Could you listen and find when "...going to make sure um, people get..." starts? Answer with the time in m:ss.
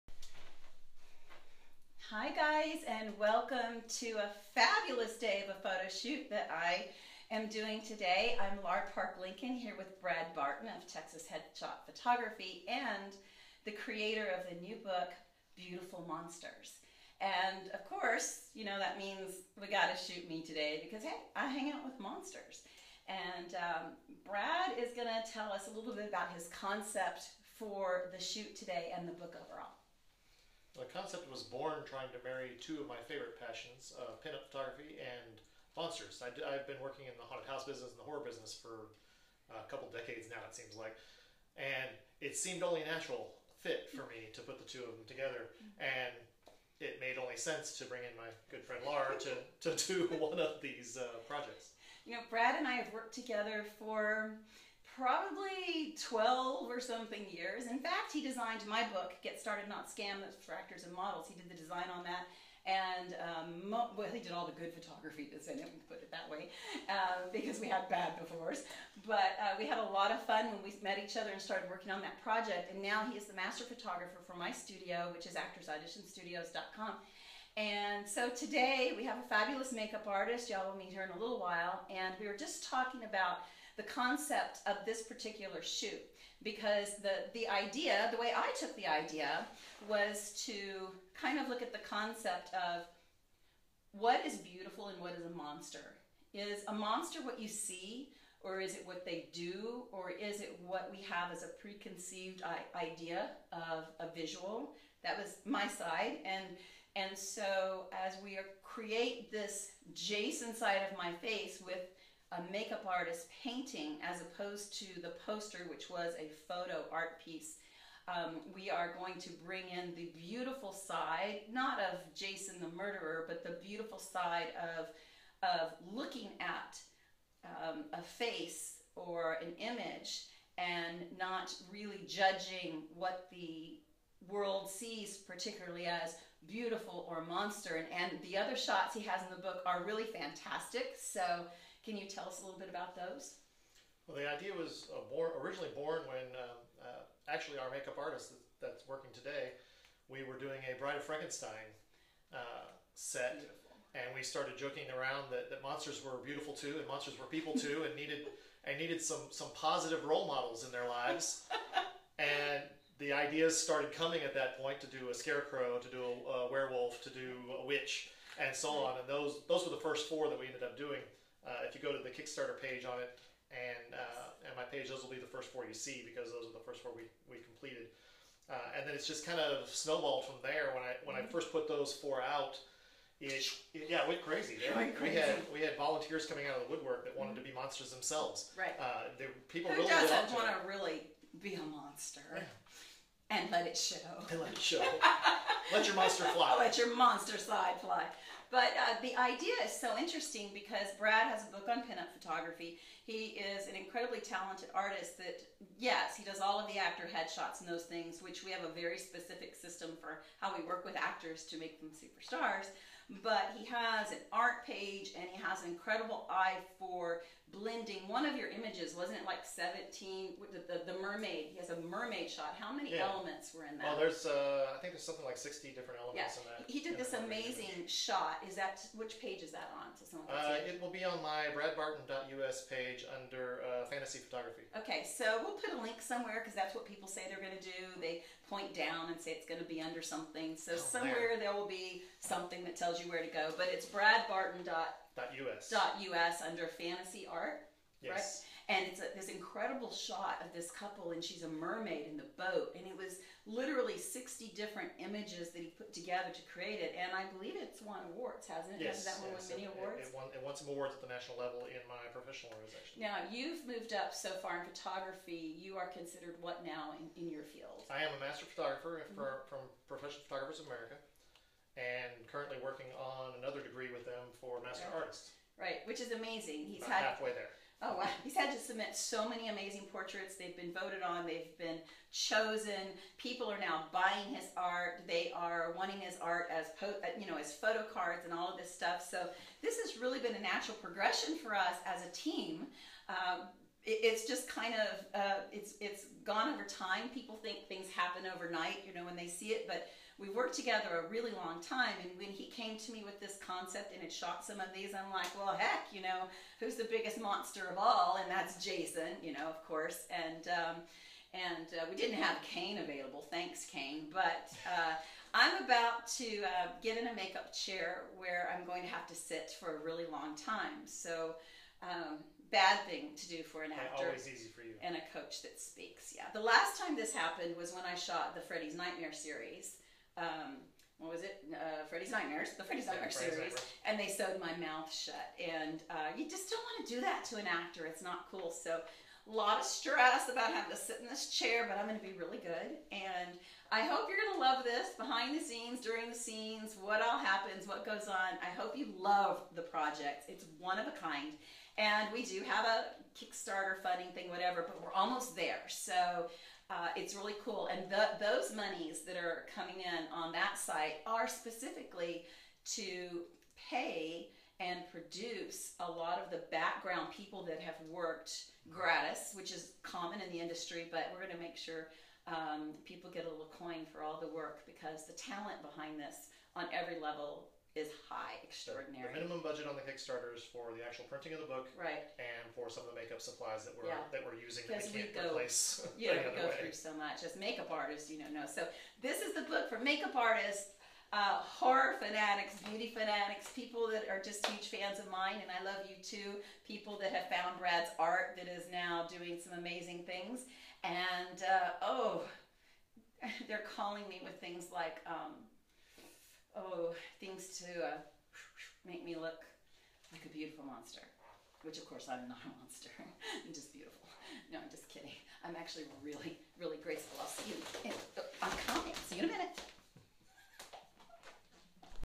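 6:11.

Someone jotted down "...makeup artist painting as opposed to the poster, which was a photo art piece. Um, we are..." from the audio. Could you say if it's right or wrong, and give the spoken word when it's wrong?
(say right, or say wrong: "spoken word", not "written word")
right.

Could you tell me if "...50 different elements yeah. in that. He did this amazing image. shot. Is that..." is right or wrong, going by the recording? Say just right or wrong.
wrong.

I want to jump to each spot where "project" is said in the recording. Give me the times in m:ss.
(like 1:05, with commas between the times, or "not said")
0:51, 1:12, 5:49.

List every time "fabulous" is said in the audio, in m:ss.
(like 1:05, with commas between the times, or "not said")
0:04, 1:19.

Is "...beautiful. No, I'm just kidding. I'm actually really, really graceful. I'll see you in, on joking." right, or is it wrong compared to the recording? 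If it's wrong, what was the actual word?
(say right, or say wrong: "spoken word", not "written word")
wrong: "coming", not "joking".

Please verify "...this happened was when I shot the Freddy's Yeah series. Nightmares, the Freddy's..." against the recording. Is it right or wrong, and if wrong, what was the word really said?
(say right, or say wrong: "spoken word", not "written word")
wrong: "Nightmare", not "Yeah".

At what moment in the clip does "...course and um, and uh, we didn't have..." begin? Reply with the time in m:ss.
5:09.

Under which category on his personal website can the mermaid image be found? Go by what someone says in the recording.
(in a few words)
fantasy photography.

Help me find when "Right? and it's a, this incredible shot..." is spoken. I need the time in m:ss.
4:08.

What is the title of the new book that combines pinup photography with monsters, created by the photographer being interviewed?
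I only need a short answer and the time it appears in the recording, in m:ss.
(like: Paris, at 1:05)
Beautiful Monsters, at 0:15.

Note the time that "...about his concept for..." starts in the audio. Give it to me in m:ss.
0:26.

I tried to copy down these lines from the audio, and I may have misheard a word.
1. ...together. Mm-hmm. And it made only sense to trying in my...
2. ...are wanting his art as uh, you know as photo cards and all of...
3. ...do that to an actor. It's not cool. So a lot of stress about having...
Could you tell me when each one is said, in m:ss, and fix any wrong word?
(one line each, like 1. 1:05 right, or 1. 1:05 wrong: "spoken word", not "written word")
1. 0:45 wrong: "bring", not "trying"
2. 4:45 right
3. 5:36 right.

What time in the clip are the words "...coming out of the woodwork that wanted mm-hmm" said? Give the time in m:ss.
3:06.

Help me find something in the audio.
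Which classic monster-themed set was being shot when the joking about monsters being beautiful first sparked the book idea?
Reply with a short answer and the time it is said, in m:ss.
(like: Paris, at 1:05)
Bride of Frankenstein, at 2:30.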